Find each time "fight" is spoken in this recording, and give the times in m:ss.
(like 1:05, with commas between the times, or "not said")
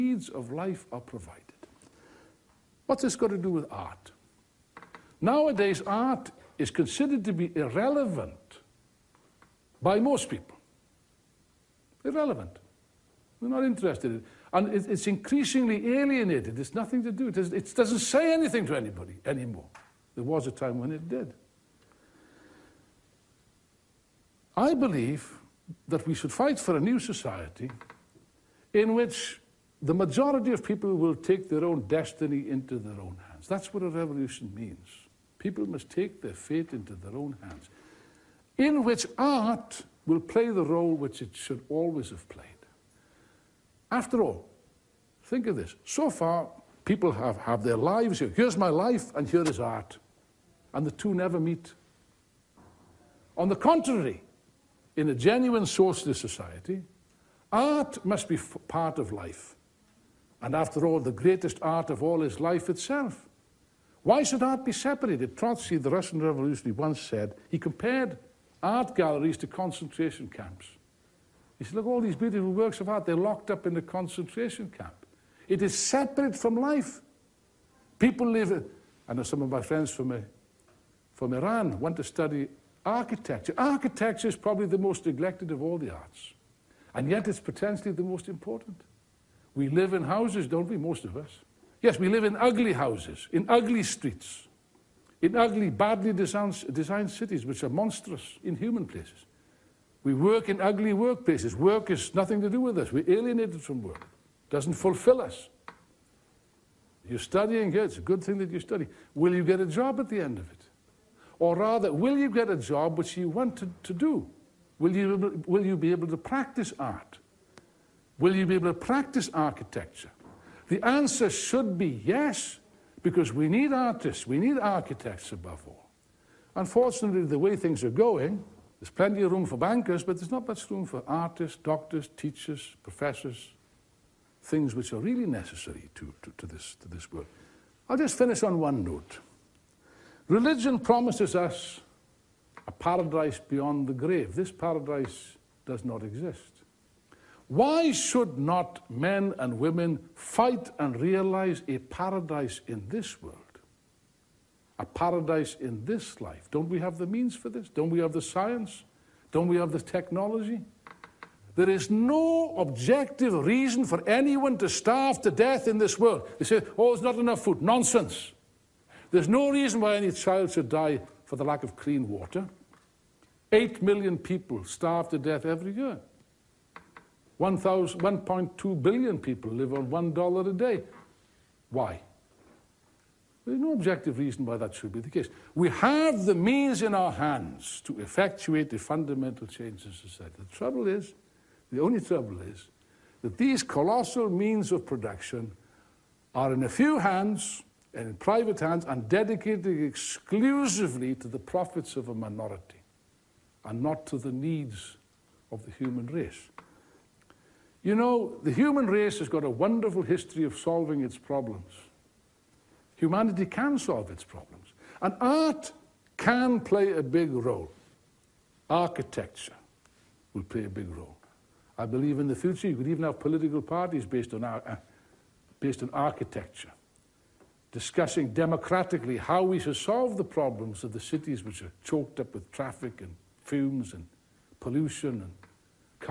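0:26, 2:30.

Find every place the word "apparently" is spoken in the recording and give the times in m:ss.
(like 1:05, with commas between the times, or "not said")
not said.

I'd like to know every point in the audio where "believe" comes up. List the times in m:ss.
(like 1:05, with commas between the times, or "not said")
0:24, 3:41.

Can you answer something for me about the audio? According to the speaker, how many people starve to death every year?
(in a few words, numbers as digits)
8 million.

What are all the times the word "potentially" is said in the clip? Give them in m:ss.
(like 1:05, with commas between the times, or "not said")
1:27.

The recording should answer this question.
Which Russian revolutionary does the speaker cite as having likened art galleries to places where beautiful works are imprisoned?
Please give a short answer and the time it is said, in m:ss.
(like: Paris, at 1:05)
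Trotsky, at 1:05.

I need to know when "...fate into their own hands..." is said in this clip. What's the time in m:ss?
0:36.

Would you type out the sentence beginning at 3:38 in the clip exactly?
Architecture will play a big role.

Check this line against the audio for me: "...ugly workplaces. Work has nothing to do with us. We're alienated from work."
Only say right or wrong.
right.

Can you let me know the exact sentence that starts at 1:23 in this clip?
Architecture is probably the most neglected of all the arts.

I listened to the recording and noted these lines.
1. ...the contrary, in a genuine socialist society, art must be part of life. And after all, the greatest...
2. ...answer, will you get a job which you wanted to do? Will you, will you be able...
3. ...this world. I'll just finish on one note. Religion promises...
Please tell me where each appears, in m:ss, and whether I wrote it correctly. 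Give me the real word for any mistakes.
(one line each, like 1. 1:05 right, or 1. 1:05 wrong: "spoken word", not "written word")
1. 0:53 right
2. 1:51 wrong: "rather", not "answer"
3. 2:16 right.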